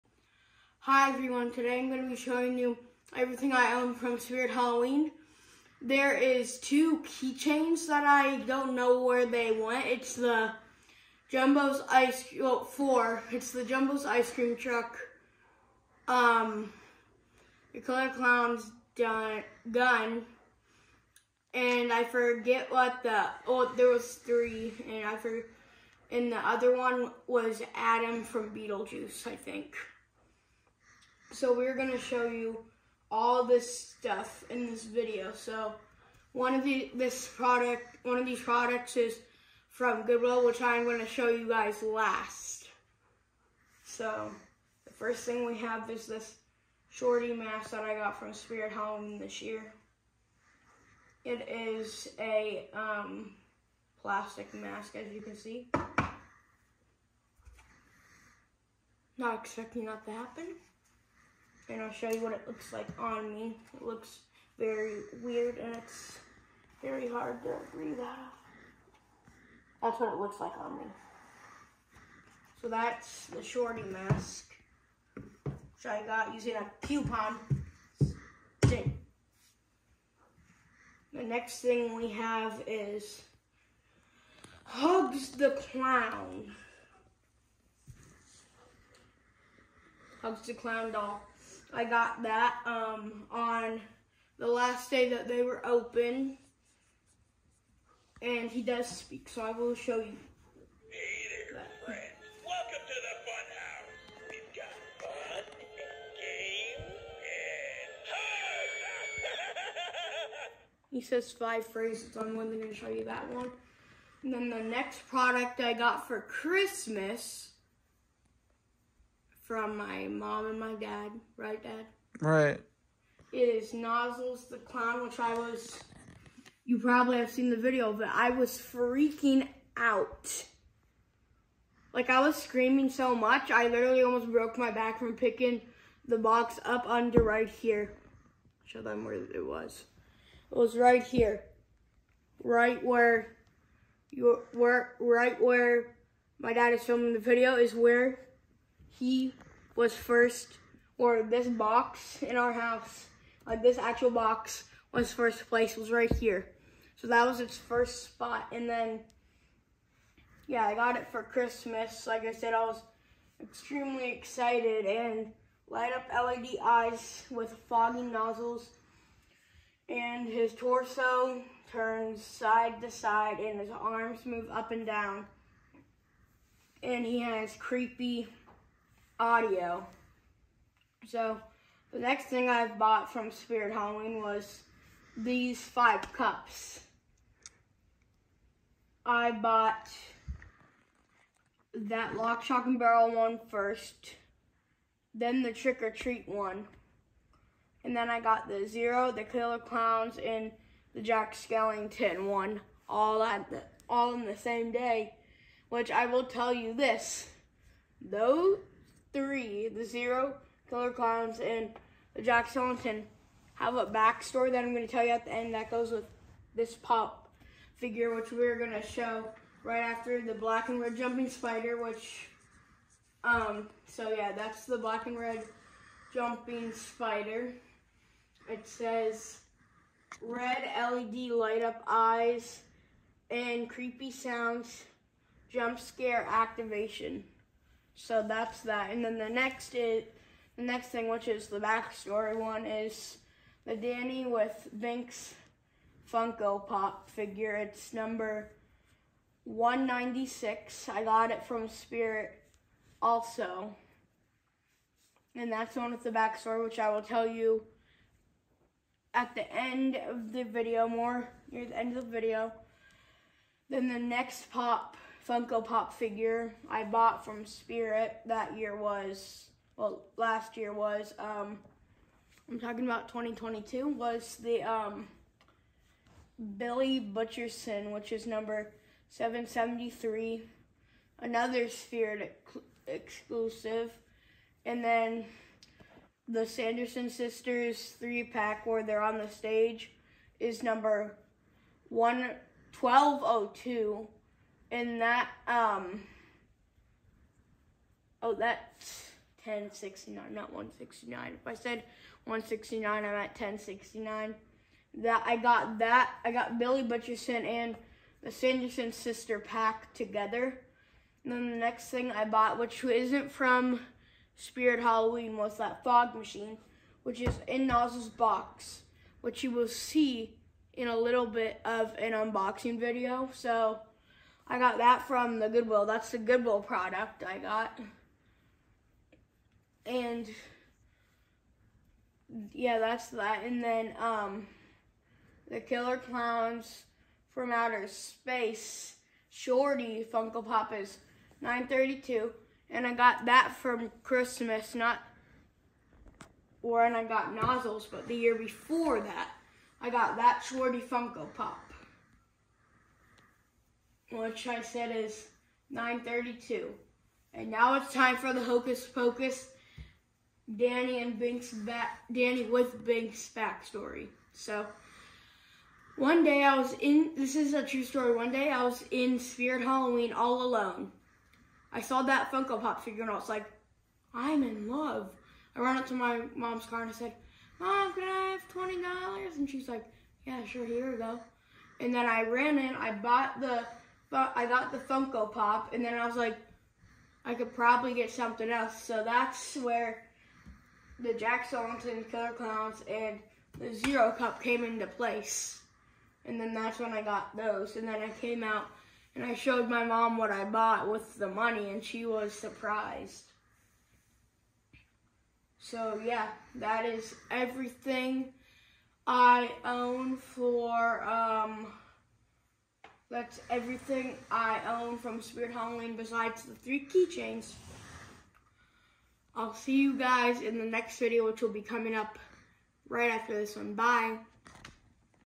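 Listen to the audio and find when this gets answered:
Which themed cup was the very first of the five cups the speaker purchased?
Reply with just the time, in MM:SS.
03:12.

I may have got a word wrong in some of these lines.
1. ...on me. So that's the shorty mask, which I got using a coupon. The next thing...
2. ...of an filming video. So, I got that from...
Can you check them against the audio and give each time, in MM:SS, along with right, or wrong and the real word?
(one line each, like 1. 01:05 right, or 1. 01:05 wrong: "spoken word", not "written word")
1. 01:10 right
2. 05:21 wrong: "unboxing", not "filming".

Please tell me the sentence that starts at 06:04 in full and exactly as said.
So, one day I was in, this is a true story, one day I was in Spirit Halloween all alone.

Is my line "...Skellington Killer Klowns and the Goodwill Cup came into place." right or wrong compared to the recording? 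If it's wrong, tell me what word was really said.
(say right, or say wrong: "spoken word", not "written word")
wrong: "Zero", not "Goodwill".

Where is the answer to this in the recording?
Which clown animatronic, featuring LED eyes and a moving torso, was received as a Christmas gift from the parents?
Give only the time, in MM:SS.
02:03.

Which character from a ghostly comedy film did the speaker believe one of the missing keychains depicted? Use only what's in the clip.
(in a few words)
Adam.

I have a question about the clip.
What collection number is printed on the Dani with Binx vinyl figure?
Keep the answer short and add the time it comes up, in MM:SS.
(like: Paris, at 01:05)
196, at 04:09.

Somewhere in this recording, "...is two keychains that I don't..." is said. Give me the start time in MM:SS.
00:06.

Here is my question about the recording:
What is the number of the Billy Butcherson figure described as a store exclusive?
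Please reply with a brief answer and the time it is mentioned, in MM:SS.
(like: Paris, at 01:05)
773, at 04:39.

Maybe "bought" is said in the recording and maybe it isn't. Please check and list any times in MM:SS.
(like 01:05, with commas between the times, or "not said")
03:02, 03:09, 04:26, 05:12, 06:22, 06:40.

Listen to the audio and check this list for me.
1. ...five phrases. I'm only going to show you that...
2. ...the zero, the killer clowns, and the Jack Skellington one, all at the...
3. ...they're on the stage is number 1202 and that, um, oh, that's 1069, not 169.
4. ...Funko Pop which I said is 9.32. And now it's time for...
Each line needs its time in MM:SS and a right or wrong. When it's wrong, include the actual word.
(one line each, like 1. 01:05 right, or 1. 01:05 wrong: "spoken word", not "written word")
1. 01:51 right
2. 03:18 right
3. 04:48 right
4. 05:50 right.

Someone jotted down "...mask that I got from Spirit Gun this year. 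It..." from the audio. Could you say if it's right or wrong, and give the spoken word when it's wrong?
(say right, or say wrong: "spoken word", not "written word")
wrong: "Halloween", not "Gun".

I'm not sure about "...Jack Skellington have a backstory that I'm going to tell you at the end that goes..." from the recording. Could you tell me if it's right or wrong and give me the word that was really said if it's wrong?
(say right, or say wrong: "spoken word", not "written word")
right.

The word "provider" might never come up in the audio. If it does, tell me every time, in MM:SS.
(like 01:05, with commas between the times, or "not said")
not said.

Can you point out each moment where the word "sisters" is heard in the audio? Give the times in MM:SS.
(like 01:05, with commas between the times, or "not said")
04:47, 05:08.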